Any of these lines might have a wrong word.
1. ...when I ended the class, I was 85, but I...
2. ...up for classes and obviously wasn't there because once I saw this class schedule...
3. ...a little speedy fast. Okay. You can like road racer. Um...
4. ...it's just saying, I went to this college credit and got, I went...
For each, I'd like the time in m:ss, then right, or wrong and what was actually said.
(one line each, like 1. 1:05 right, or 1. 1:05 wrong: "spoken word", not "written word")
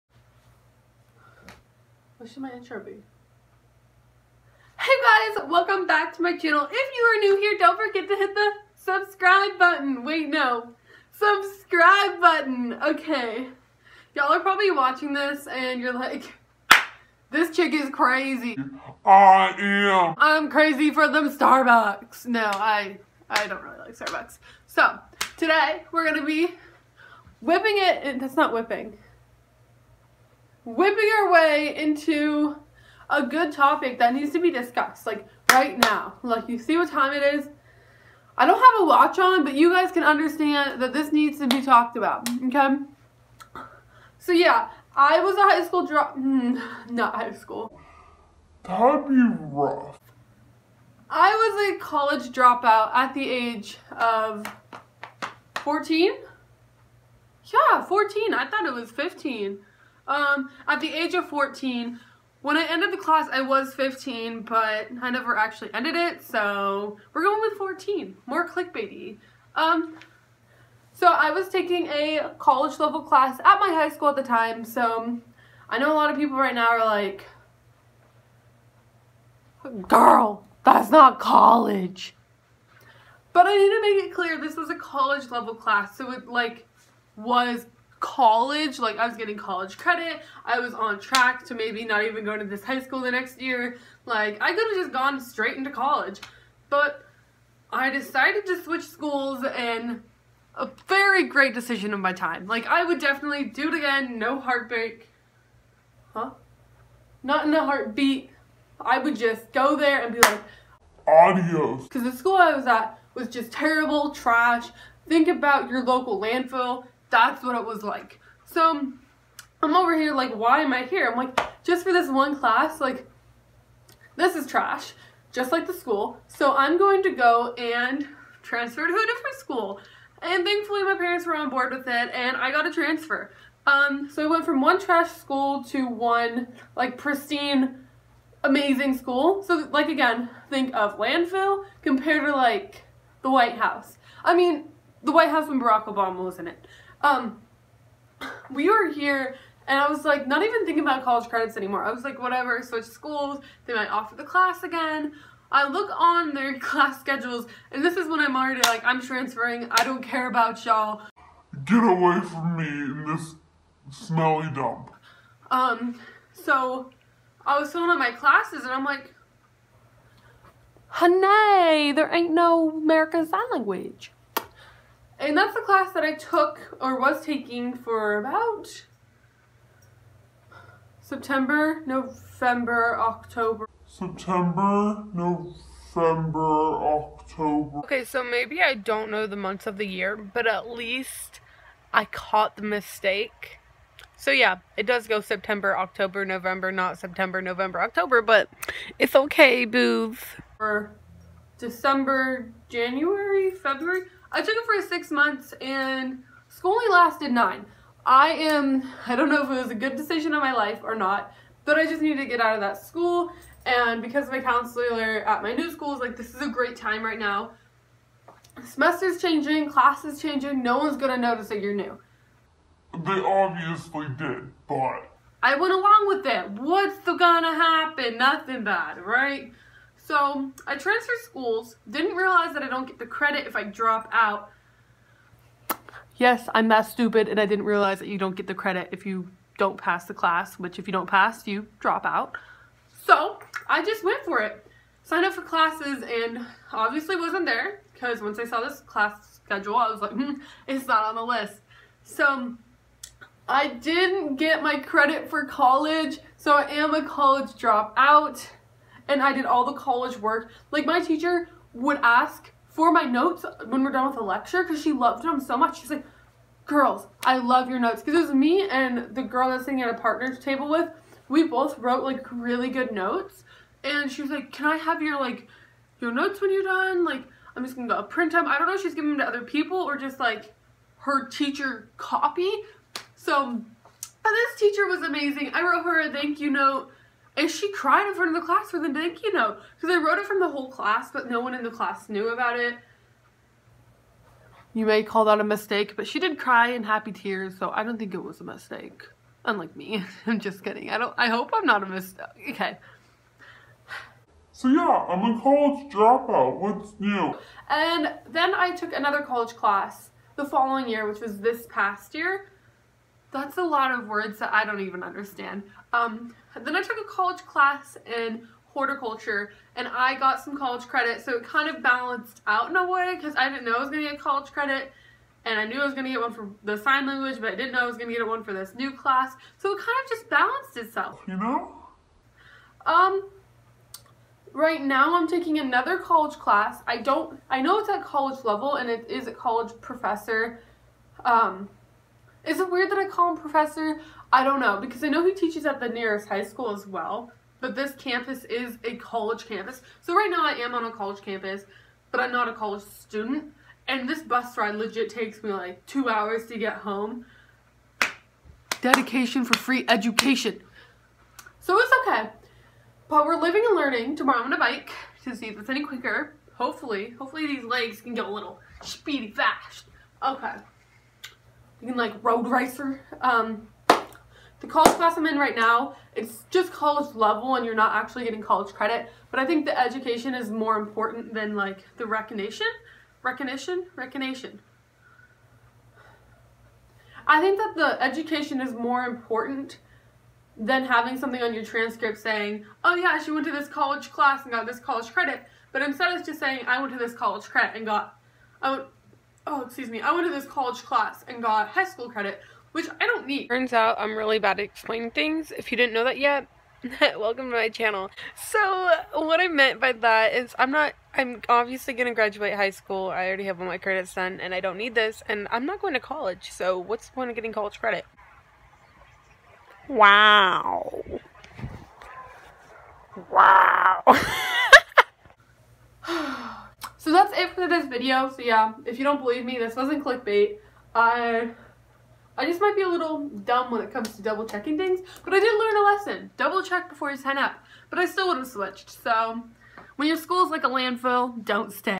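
1. 1:02 wrong: "15", not "85"
2. 4:05 right
3. 6:08 right
4. 6:36 right.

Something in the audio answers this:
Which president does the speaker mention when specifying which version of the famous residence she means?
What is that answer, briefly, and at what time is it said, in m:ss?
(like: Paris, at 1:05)
Barack Obama, at 2:25.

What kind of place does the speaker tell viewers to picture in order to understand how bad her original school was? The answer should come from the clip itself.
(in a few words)
Local landfill.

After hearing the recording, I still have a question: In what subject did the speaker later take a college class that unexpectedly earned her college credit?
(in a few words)
Horticulture.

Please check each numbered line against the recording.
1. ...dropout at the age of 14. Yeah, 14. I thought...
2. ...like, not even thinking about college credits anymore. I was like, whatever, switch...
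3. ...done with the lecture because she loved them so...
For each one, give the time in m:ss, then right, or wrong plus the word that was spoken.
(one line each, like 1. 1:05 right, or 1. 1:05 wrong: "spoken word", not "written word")
1. 0:52 right
2. 2:30 right
3. 4:23 right.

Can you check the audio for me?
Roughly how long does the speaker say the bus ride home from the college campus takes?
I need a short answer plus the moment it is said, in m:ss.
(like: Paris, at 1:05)
2 hours, at 5:55.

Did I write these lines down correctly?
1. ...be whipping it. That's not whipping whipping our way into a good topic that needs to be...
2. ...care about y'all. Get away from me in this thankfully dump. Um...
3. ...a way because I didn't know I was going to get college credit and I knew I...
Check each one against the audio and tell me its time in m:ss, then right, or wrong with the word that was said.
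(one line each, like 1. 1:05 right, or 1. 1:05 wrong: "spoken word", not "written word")
1. 0:26 right
2. 2:40 wrong: "smelly", not "thankfully"
3. 5:22 right.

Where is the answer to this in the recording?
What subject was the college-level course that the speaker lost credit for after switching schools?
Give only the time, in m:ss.
2:52.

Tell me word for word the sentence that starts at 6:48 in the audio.
So what I meant by that is I'm not, I'm obviously going to graduate high school.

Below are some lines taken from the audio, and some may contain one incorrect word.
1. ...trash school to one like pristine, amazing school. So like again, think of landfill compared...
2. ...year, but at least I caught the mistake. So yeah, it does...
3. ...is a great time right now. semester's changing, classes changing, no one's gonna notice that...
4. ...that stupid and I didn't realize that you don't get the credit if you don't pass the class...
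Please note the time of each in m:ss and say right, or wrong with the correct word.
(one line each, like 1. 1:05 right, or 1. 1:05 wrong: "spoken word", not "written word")
1. 2:14 right
2. 3:09 right
3. 3:36 right
4. 3:56 right.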